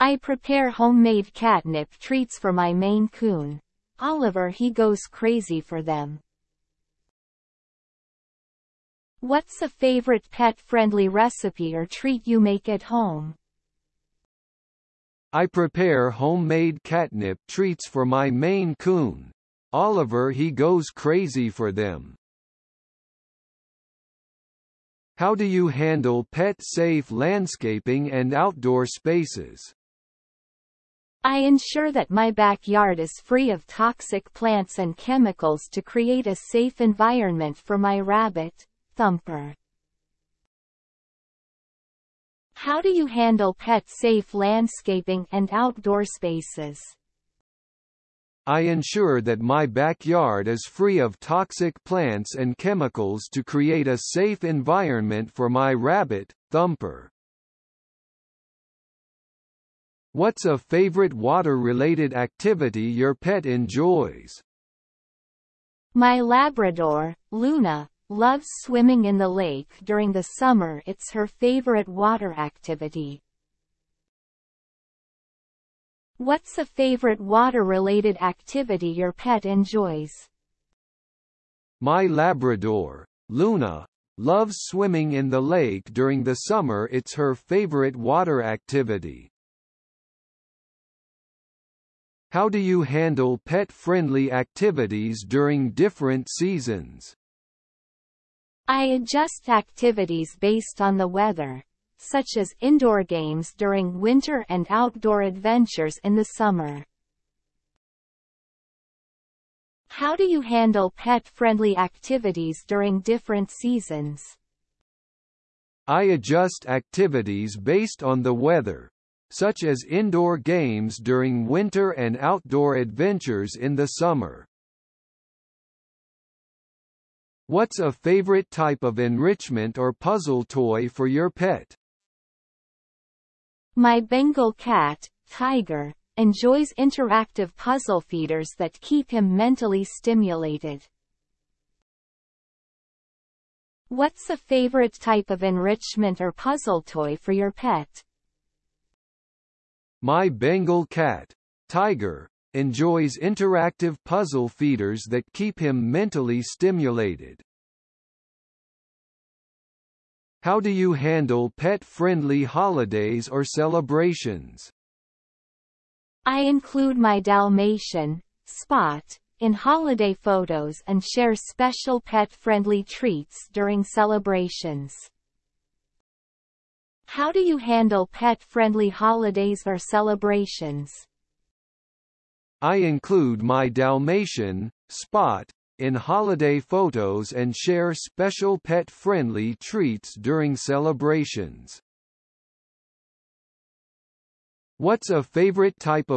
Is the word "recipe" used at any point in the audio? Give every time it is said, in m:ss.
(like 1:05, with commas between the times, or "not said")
0:11.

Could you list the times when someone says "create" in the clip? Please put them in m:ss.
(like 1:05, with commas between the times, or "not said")
0:35, 0:53.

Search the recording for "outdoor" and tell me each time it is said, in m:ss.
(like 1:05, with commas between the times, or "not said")
0:28, 0:45, 1:44, 2:02.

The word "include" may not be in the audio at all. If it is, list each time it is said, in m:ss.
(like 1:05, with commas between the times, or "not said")
2:46, 3:02.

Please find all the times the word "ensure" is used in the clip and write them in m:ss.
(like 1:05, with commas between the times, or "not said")
0:31, 0:48.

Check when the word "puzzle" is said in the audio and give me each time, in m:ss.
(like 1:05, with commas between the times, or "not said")
2:09, 2:17, 2:26, 2:34.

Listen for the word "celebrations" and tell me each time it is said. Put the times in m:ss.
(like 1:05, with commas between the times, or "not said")
2:43, 2:53, 2:59, 3:10.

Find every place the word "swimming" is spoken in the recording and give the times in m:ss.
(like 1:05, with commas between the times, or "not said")
1:08, 1:24.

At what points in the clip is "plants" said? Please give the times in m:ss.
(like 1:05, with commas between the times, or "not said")
0:34, 0:51.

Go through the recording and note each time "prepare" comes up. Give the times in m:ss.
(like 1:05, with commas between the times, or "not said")
0:00, 0:15.